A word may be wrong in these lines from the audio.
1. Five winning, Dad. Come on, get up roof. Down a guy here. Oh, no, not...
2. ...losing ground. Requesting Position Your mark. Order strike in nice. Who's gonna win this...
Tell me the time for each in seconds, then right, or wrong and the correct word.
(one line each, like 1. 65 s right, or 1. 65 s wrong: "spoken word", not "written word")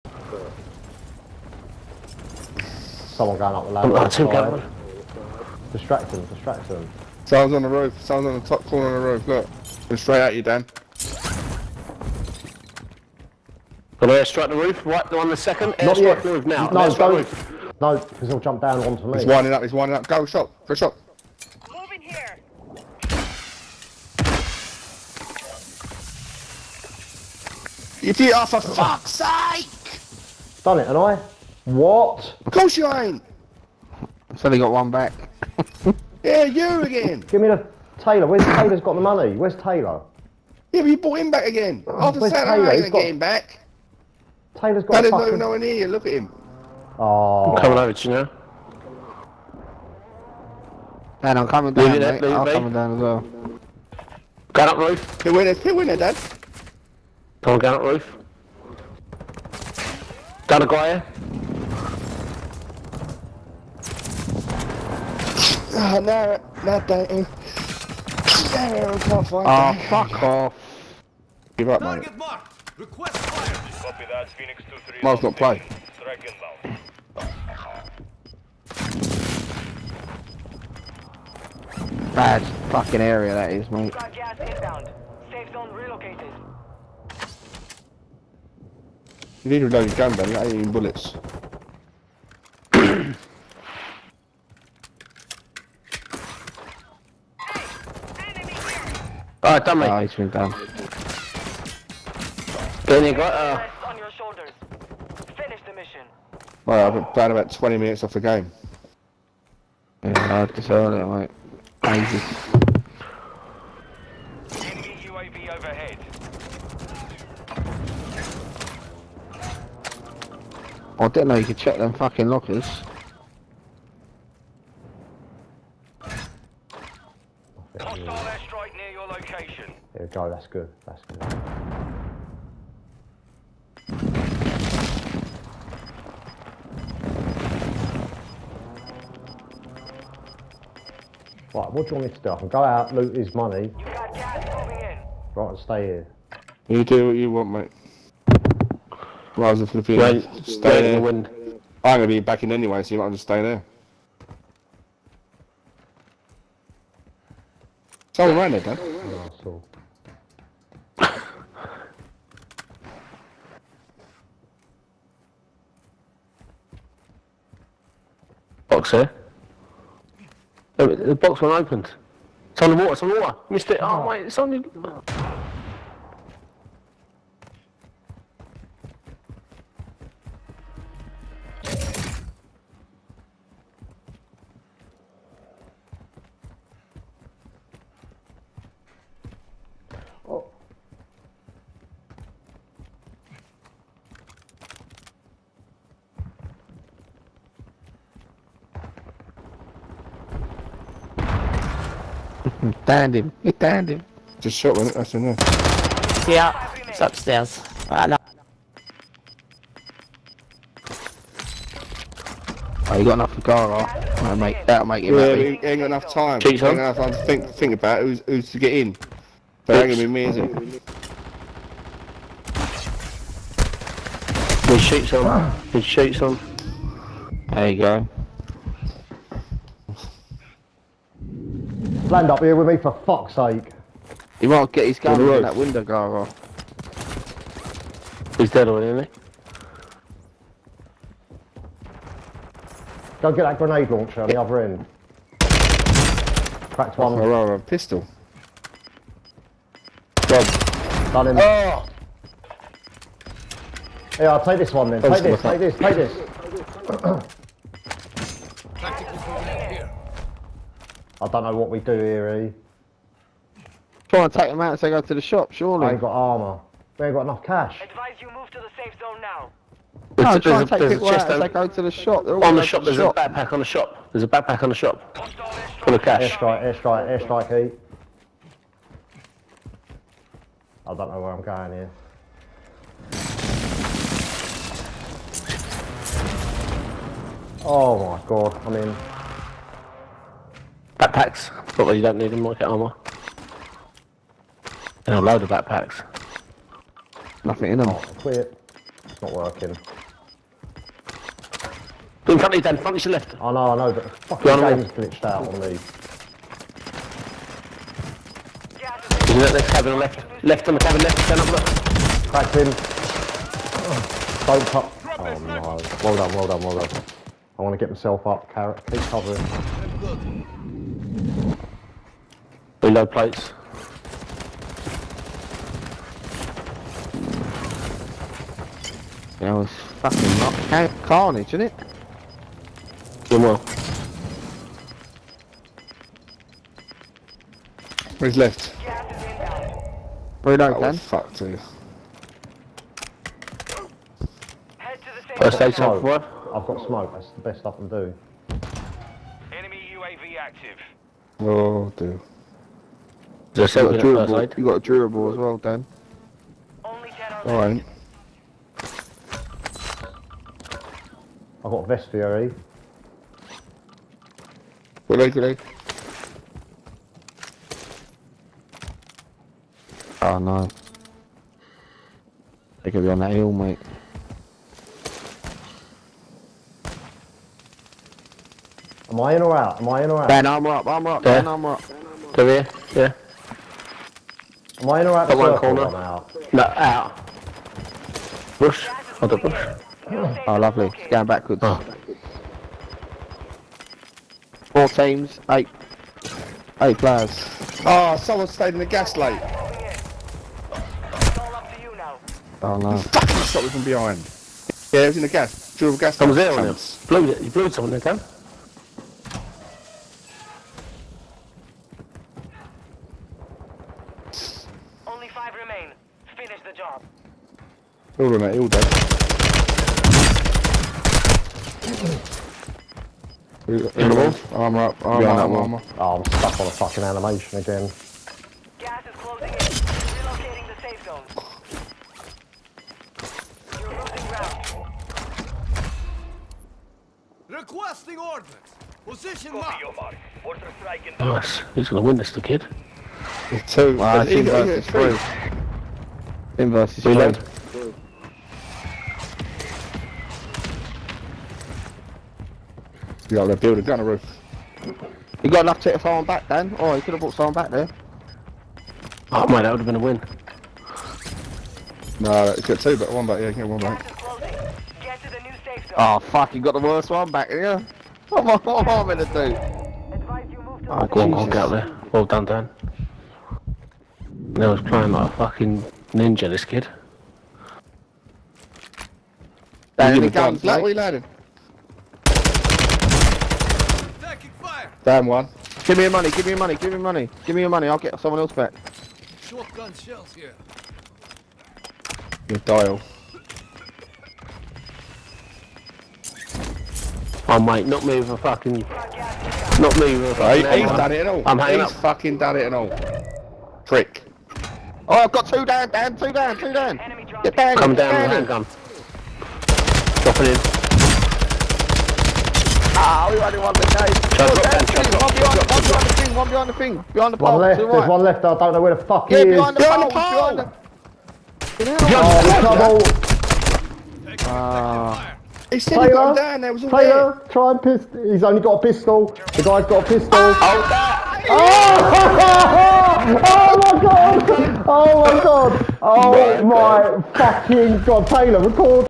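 1. 55 s wrong: "Two", not "Five"
2. 433 s right.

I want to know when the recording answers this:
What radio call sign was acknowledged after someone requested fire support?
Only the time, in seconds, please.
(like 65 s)
74 s.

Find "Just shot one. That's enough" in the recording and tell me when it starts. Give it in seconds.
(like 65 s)
204 s.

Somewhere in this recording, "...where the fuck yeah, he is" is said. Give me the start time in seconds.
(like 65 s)
518 s.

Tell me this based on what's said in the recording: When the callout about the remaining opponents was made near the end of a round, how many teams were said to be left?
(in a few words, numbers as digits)
4.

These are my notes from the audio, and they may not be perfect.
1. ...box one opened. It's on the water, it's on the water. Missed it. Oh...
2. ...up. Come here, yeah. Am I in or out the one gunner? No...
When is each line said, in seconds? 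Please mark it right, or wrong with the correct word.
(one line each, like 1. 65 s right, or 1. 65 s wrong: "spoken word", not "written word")
1. 171 s right
2. 381 s wrong: "corner", not "gunner".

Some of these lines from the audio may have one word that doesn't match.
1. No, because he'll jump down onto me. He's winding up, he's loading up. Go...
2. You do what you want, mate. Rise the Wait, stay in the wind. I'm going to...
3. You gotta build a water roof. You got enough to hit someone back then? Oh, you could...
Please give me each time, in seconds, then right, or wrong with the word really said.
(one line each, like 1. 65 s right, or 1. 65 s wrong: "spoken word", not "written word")
1. 17 s wrong: "winding", not "loading"
2. 146 s right
3. 453 s wrong: "gunner", not "water".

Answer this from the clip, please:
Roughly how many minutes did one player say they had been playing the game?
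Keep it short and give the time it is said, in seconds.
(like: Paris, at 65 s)
20, at 107 s.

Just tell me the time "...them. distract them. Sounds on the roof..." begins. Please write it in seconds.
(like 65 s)
6 s.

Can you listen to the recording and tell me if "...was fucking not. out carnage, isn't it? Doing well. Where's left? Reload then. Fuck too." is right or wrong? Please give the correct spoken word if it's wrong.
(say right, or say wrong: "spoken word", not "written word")
right.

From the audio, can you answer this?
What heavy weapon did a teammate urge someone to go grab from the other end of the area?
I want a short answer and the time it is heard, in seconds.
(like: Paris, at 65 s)
grenade launcher, at 243 s.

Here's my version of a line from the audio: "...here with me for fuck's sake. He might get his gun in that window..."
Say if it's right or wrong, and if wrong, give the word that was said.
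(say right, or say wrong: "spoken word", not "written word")
right.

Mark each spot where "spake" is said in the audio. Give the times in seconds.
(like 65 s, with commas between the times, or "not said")
not said.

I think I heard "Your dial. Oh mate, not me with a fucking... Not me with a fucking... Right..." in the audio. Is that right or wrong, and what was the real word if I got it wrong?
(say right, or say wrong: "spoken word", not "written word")
right.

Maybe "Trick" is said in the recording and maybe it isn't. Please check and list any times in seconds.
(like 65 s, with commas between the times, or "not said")
503 s.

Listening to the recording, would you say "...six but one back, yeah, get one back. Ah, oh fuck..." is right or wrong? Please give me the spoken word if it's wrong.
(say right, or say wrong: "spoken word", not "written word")
wrong: "two", not "six".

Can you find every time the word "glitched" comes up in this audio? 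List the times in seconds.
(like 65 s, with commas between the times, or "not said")
304 s.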